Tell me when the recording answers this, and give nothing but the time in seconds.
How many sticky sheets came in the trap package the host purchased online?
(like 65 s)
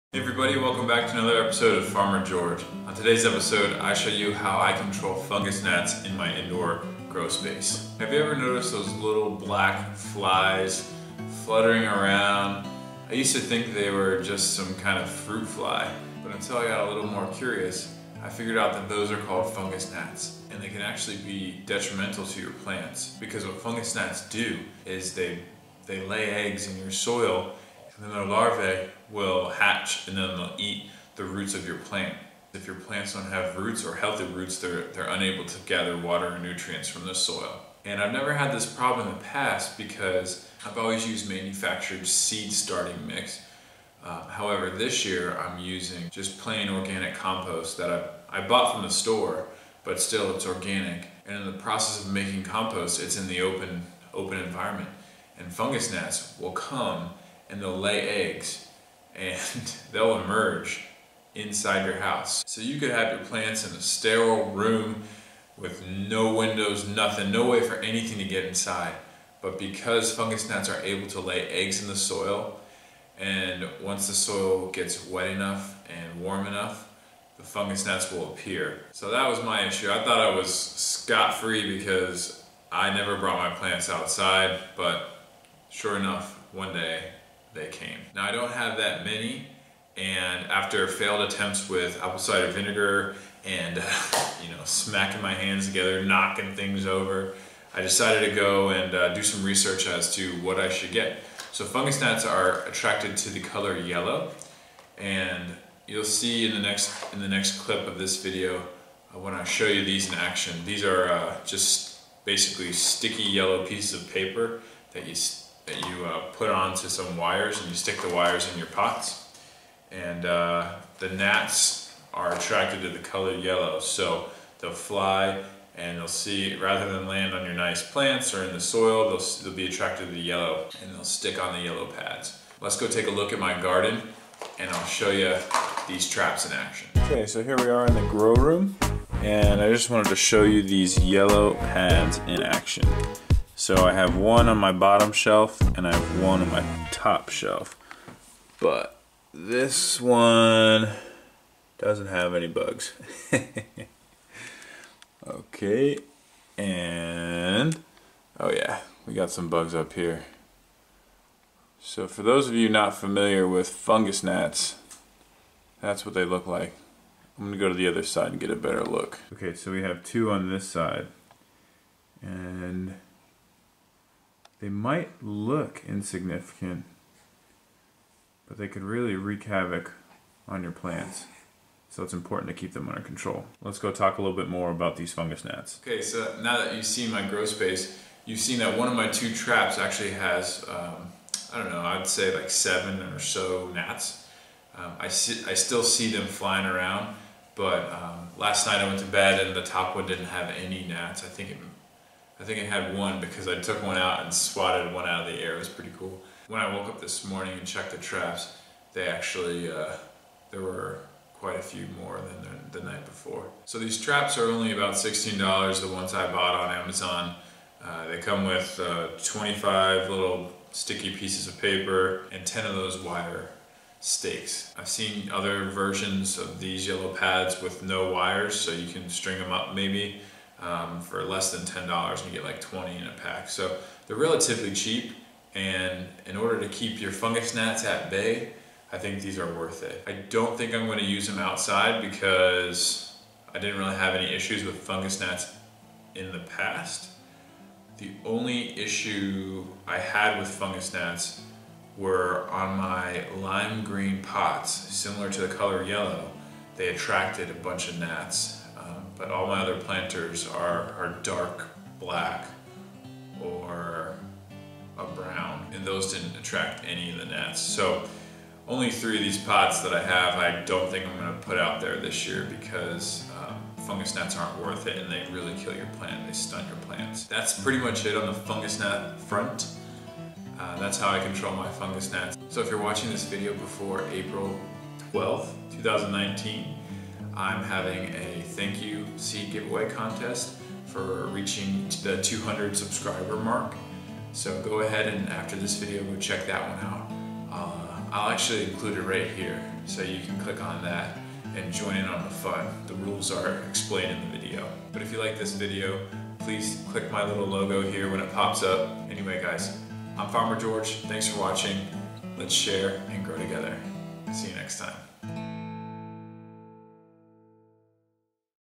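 219 s.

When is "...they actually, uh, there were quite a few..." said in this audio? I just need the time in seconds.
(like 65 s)
208 s.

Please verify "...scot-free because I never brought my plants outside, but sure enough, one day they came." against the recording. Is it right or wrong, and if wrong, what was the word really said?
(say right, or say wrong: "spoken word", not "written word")
right.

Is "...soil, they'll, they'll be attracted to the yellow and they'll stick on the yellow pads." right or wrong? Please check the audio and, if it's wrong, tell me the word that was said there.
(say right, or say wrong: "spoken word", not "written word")
right.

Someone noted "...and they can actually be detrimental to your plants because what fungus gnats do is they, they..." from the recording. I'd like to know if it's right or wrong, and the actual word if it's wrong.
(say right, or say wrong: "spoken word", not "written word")
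right.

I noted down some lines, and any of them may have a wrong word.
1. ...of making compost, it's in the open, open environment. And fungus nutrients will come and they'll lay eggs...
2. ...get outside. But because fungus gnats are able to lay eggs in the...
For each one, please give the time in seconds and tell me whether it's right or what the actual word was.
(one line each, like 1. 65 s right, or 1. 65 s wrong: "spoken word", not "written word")
1. 52 s wrong: "gnats", not "nutrients"
2. 68 s wrong: "inside", not "outside".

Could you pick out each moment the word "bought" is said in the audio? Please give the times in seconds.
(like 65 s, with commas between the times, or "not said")
48 s, 216 s.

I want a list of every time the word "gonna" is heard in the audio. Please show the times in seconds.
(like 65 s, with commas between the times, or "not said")
167 s, 271 s.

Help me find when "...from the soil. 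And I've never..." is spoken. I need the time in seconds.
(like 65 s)
36 s.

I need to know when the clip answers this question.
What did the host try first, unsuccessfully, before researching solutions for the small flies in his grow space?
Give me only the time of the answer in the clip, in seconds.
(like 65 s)
92 s.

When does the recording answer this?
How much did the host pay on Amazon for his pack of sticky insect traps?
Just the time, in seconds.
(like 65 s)
214 s.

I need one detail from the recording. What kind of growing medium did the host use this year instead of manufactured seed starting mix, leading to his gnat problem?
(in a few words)
Organic compost.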